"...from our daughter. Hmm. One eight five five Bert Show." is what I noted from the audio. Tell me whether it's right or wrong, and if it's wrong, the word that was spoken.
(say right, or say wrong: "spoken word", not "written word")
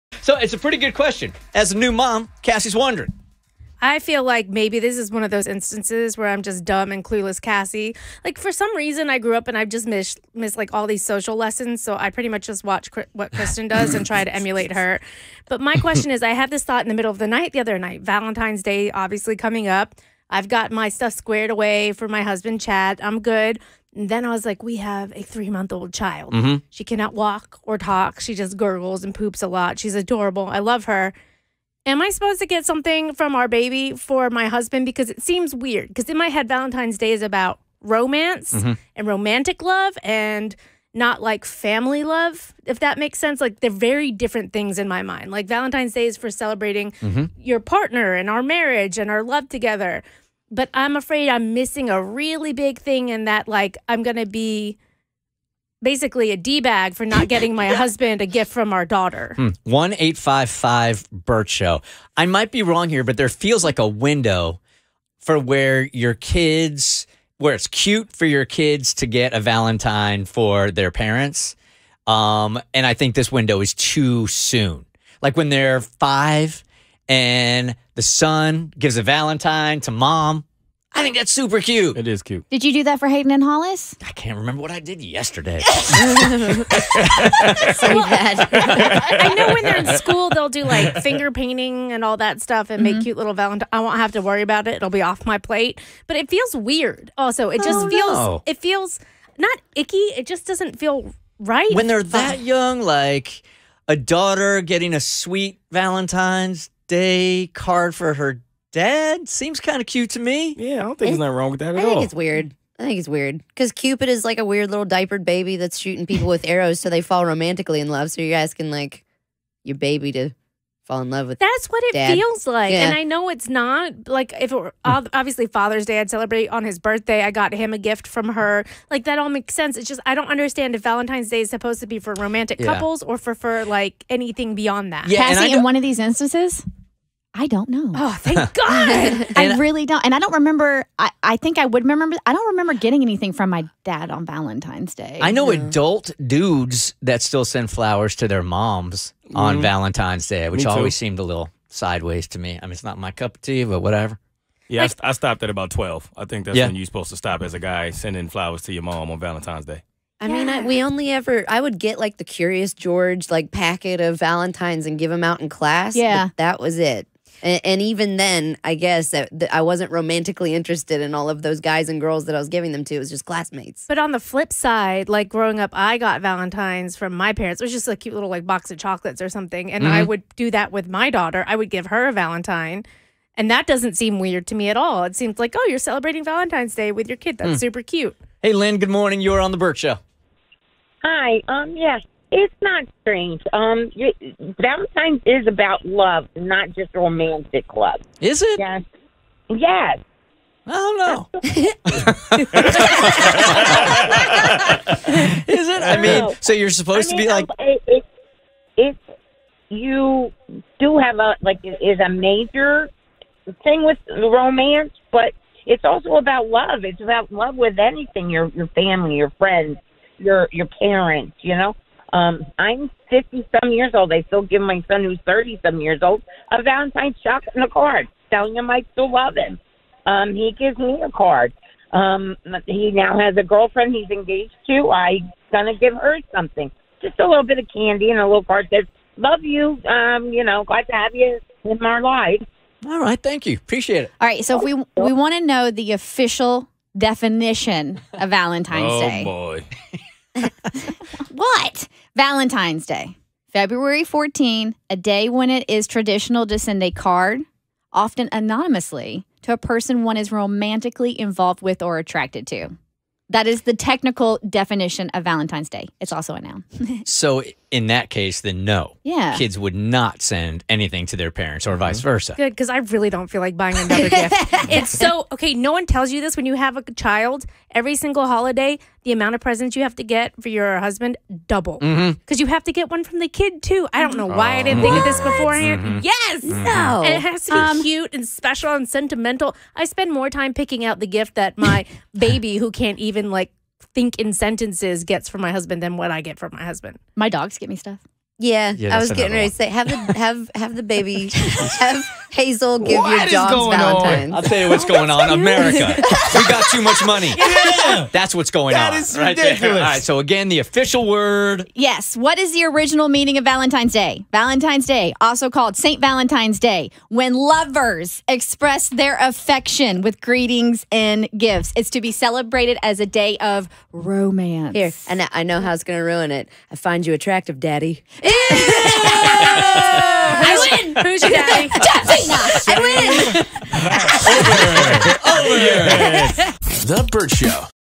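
right.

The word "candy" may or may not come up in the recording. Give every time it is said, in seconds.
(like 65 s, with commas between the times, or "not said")
237 s.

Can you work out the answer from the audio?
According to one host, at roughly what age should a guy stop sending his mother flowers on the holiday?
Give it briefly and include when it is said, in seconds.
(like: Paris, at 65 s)
12, at 155 s.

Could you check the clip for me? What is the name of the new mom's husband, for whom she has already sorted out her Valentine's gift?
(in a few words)
Chad.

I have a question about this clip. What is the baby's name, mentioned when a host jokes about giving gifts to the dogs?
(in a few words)
Hazel.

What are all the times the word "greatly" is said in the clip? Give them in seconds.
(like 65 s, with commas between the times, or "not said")
not said.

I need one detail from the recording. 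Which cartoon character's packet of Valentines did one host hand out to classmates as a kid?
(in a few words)
Curious George.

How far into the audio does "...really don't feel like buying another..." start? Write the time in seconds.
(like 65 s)
272 s.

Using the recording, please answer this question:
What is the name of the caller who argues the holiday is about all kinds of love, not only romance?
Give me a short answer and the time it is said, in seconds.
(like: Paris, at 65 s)
Lynn, at 188 s.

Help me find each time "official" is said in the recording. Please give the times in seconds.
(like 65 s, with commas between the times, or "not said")
245 s, 310 s.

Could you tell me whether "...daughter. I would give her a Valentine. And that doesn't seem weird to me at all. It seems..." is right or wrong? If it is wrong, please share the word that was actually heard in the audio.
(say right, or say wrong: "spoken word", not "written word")
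right.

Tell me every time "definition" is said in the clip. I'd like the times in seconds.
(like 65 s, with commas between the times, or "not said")
246 s, 264 s.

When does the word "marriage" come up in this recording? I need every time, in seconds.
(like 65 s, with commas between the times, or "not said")
48 s.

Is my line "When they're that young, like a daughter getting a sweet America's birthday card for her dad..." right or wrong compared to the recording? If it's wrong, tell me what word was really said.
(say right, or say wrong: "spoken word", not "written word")
wrong: "Valentine", not "America".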